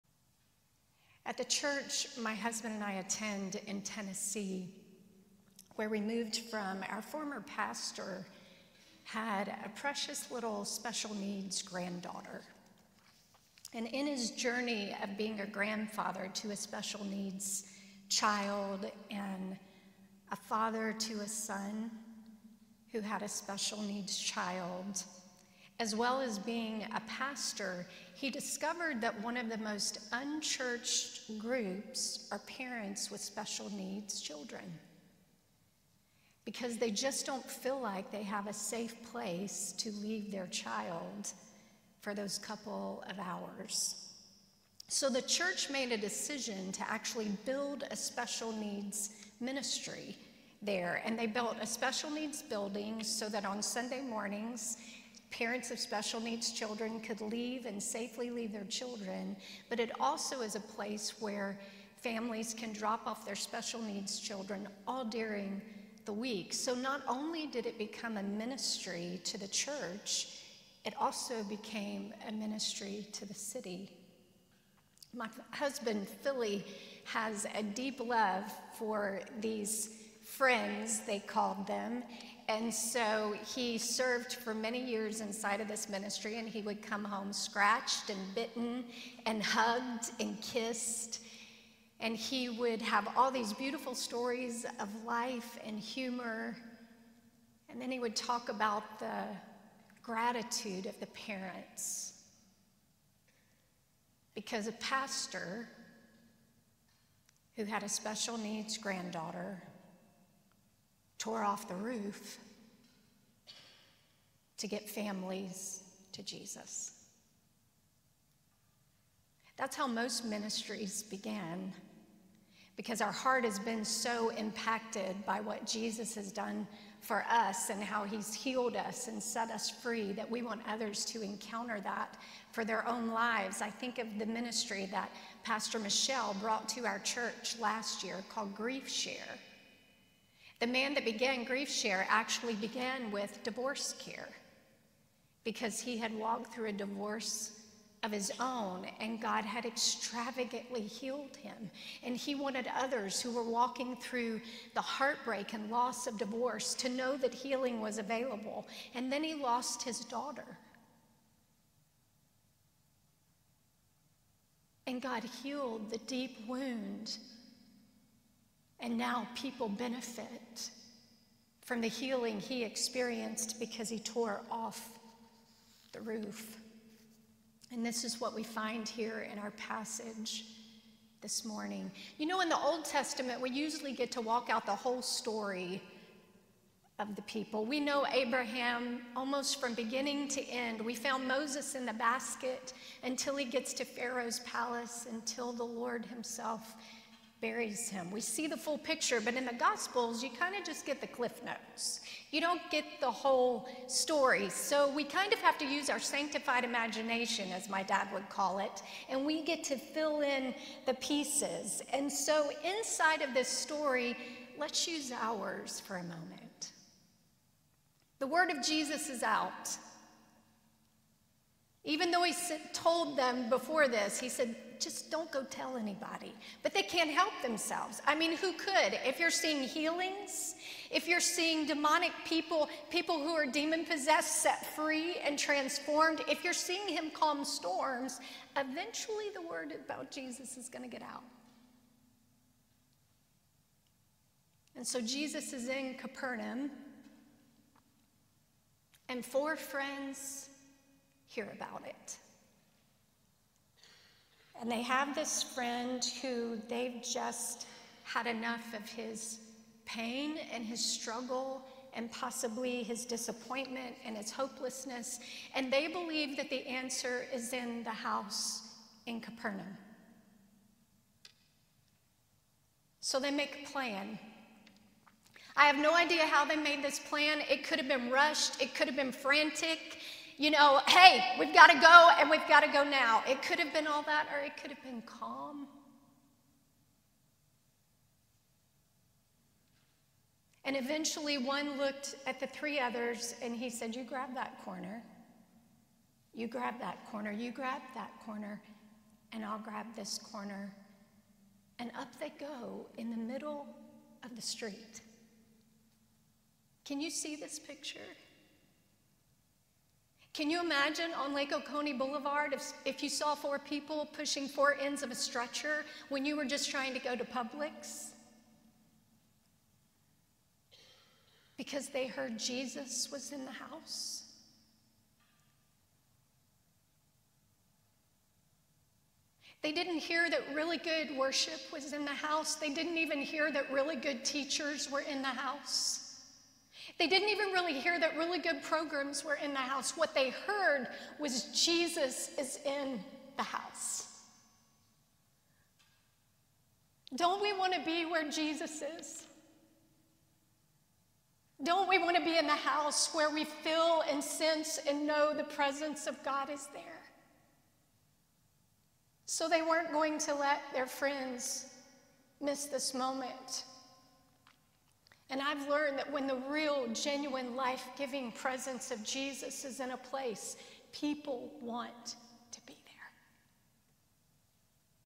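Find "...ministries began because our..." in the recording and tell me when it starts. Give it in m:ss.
2:00.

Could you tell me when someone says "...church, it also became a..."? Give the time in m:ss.
1:09.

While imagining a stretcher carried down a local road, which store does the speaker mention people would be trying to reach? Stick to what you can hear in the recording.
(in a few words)
Publix.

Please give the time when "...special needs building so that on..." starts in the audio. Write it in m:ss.
0:51.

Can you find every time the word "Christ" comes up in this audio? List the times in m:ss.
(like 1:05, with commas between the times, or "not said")
not said.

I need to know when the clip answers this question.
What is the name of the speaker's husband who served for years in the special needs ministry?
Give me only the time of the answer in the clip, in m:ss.
1:16.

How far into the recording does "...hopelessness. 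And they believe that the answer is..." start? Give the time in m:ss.
4:24.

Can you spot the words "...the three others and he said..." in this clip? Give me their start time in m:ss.
4:52.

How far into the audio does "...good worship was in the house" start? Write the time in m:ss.
5:30.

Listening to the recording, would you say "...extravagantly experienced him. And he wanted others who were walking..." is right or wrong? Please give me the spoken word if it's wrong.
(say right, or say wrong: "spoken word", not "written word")
wrong: "healed", not "experienced".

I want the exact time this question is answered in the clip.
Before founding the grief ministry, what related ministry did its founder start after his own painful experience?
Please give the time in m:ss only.
2:23.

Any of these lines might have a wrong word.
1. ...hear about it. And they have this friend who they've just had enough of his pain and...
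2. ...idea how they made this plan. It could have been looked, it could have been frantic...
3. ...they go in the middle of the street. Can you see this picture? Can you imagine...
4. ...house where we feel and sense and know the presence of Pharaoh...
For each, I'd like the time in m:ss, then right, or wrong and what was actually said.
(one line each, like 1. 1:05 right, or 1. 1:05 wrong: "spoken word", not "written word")
1. 4:11 right
2. 4:35 wrong: "rushed", not "looked"
3. 5:02 right
4. 5:52 wrong: "God", not "Pharaoh".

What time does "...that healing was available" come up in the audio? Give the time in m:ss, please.
2:37.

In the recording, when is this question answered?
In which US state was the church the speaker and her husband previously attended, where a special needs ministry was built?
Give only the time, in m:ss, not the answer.
0:03.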